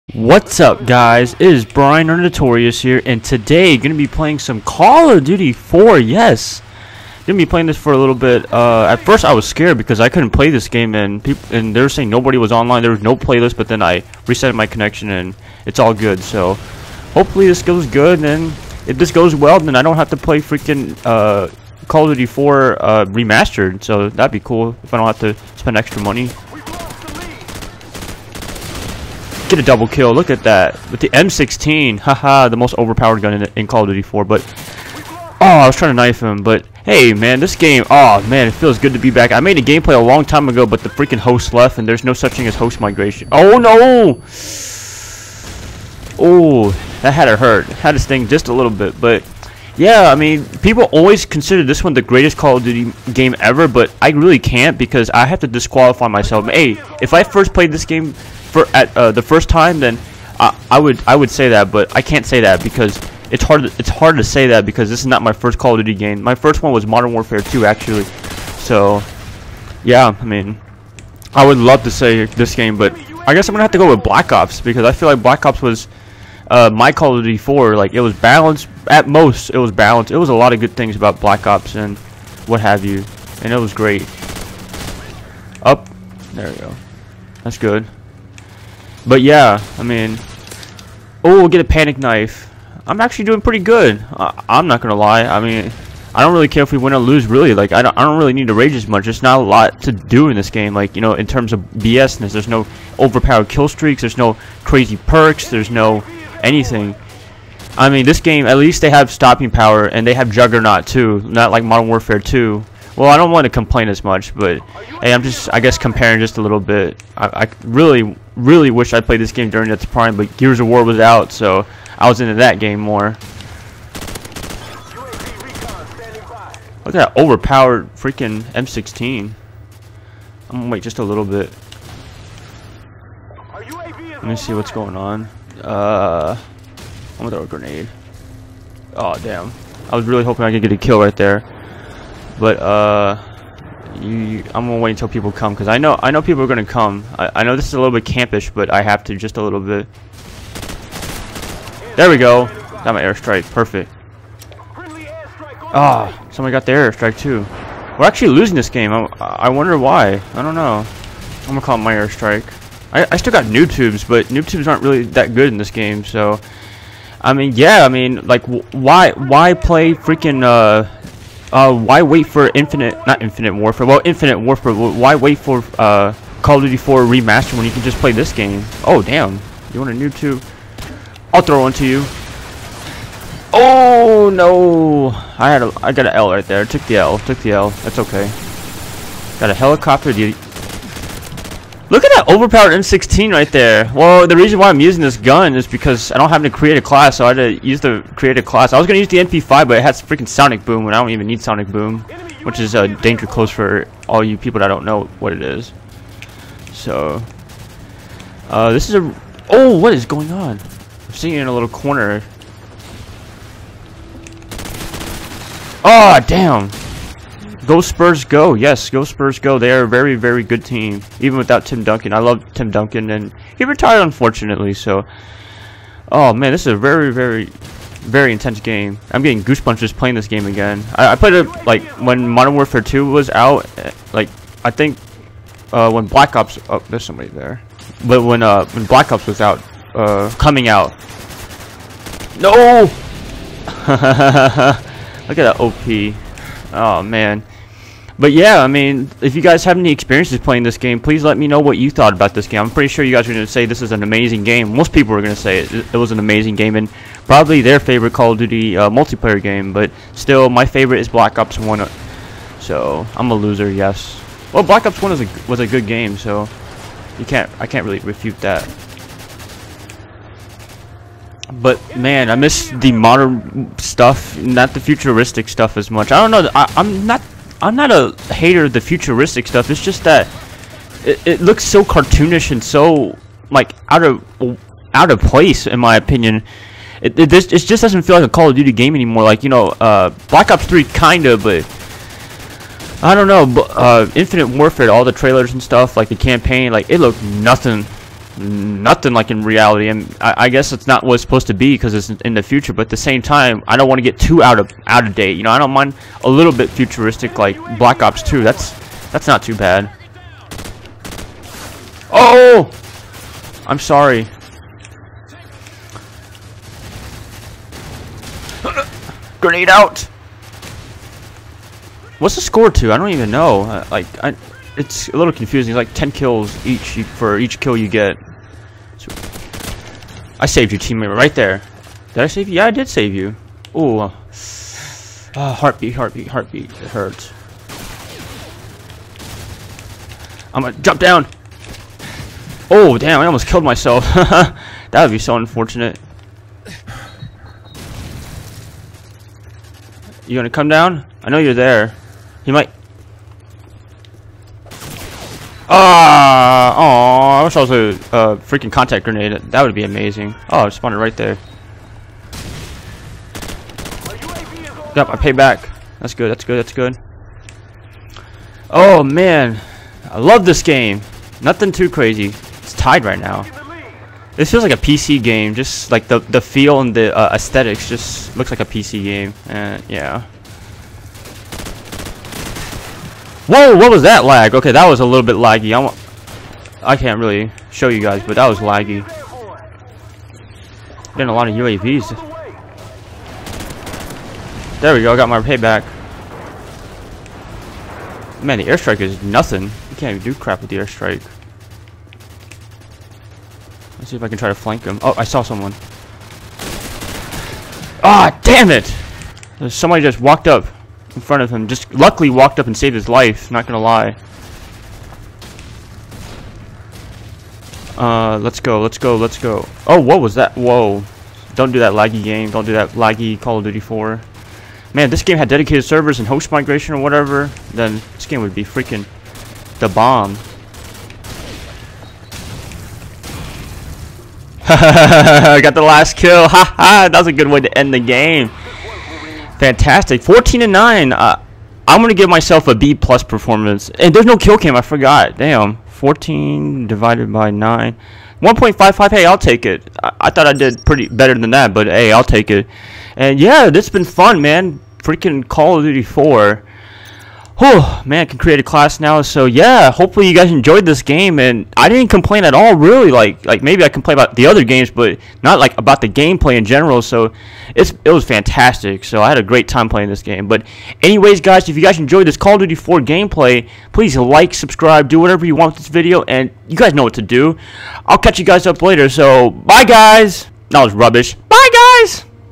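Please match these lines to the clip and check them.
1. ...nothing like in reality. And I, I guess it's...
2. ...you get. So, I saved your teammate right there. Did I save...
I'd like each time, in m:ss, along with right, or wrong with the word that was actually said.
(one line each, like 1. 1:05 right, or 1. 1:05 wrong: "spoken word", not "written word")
1. 4:58 right
2. 5:27 right.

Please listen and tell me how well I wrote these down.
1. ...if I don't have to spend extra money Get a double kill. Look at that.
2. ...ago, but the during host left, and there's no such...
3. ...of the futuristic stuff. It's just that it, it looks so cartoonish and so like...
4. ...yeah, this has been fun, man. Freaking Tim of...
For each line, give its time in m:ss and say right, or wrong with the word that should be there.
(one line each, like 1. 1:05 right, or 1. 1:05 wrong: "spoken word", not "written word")
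1. 0:24 right
2. 0:40 wrong: "freaking", not "during"
3. 4:38 right
4. 7:33 wrong: "Call", not "Tim".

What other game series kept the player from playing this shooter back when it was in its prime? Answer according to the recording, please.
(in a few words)
Gears of War.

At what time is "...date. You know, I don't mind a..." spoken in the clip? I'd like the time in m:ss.
5:05.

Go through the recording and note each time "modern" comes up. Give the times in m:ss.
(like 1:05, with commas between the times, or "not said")
1:06, 1:51, 3:52, 4:32.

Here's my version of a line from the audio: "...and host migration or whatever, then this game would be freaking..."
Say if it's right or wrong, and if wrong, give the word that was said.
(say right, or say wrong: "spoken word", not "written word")
right.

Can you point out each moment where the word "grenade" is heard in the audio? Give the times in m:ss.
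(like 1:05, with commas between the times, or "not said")
2:17, 5:19, 5:59.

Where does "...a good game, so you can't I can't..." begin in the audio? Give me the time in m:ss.
4:25.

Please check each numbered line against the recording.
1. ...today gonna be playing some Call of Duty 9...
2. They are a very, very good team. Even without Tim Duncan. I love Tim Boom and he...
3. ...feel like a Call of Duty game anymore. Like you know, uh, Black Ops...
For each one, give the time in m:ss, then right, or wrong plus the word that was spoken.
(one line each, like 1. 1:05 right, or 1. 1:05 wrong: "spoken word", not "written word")
1. 0:03 wrong: "4", not "9"
2. 3:39 wrong: "Duncan", not "Boom"
3. 4:48 right.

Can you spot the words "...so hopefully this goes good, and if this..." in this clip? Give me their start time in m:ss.
0:16.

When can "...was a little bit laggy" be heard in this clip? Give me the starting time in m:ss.
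6:24.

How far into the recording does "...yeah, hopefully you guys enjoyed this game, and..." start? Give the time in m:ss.
7:39.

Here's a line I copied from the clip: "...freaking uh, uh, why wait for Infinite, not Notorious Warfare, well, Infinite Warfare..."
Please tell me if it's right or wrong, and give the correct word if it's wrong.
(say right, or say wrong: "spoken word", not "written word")
wrong: "Infinite", not "Notorious".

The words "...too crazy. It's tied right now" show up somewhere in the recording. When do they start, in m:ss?
6:11.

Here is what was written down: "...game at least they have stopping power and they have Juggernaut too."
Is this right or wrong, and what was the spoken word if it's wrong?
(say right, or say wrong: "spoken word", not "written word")
right.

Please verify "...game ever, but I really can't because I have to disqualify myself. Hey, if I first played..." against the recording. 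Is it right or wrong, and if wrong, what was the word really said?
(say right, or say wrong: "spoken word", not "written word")
right.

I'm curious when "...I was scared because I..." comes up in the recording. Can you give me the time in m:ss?
0:09.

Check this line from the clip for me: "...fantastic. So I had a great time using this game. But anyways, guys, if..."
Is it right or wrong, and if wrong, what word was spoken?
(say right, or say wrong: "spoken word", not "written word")
wrong: "playing", not "using".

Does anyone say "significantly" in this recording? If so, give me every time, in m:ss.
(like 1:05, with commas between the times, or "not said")
not said.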